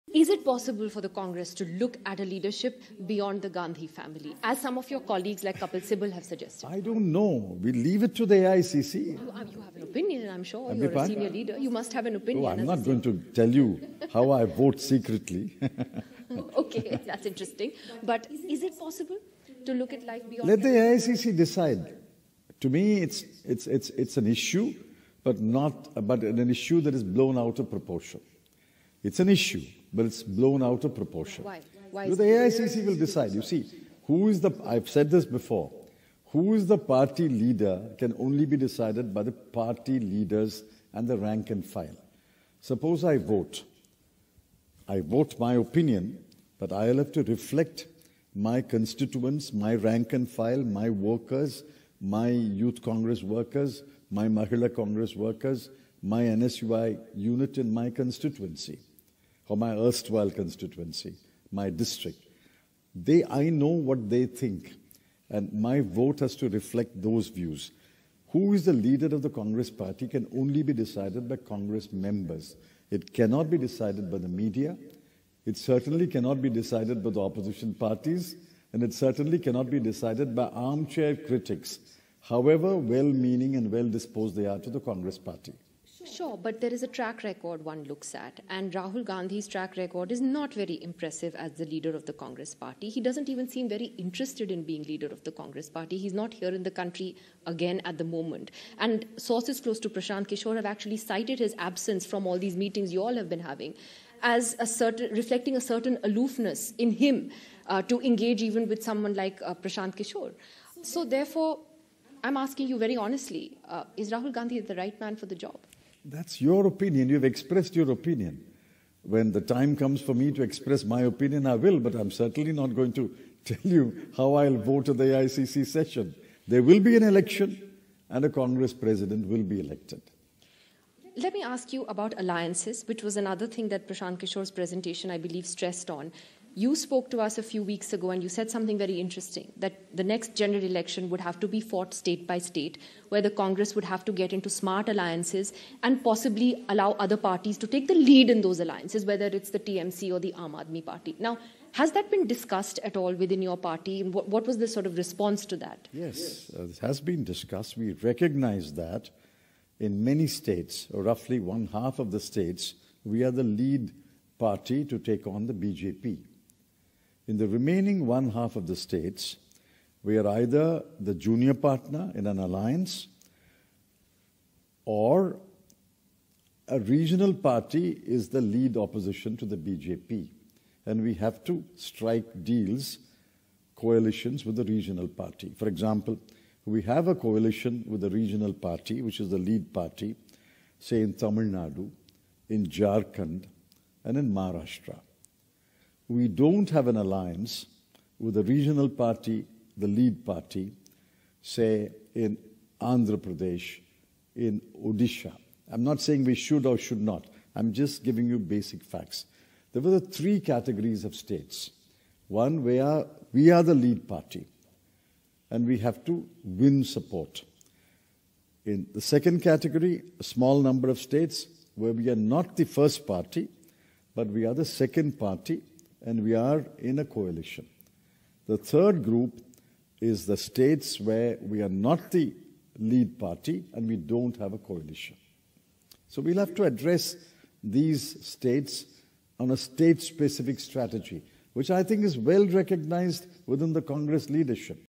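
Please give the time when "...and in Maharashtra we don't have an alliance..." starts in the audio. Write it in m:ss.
3:14.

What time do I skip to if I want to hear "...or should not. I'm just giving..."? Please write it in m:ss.
3:26.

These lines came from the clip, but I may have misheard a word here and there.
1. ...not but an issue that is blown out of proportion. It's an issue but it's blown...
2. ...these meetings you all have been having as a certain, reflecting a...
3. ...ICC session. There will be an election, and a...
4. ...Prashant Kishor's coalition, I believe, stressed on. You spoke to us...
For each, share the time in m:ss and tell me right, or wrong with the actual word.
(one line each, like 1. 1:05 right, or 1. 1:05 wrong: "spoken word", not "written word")
1. 0:25 right
2. 1:42 right
3. 2:05 right
4. 2:13 wrong: "presentation", not "coalition".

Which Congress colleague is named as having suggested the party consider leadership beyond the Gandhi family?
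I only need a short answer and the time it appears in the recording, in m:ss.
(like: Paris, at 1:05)
Kapil Sibal, at 0:05.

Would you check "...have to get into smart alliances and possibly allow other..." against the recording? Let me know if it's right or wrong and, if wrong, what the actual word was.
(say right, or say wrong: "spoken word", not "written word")
right.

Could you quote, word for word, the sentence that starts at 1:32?
He doesn't even seem very interested in being leader of the Congress party.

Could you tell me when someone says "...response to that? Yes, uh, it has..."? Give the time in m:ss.
2:34.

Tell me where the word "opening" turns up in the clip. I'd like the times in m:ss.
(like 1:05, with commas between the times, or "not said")
not said.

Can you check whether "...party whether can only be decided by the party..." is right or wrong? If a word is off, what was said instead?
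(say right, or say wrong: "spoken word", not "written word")
wrong: "leader", not "whether".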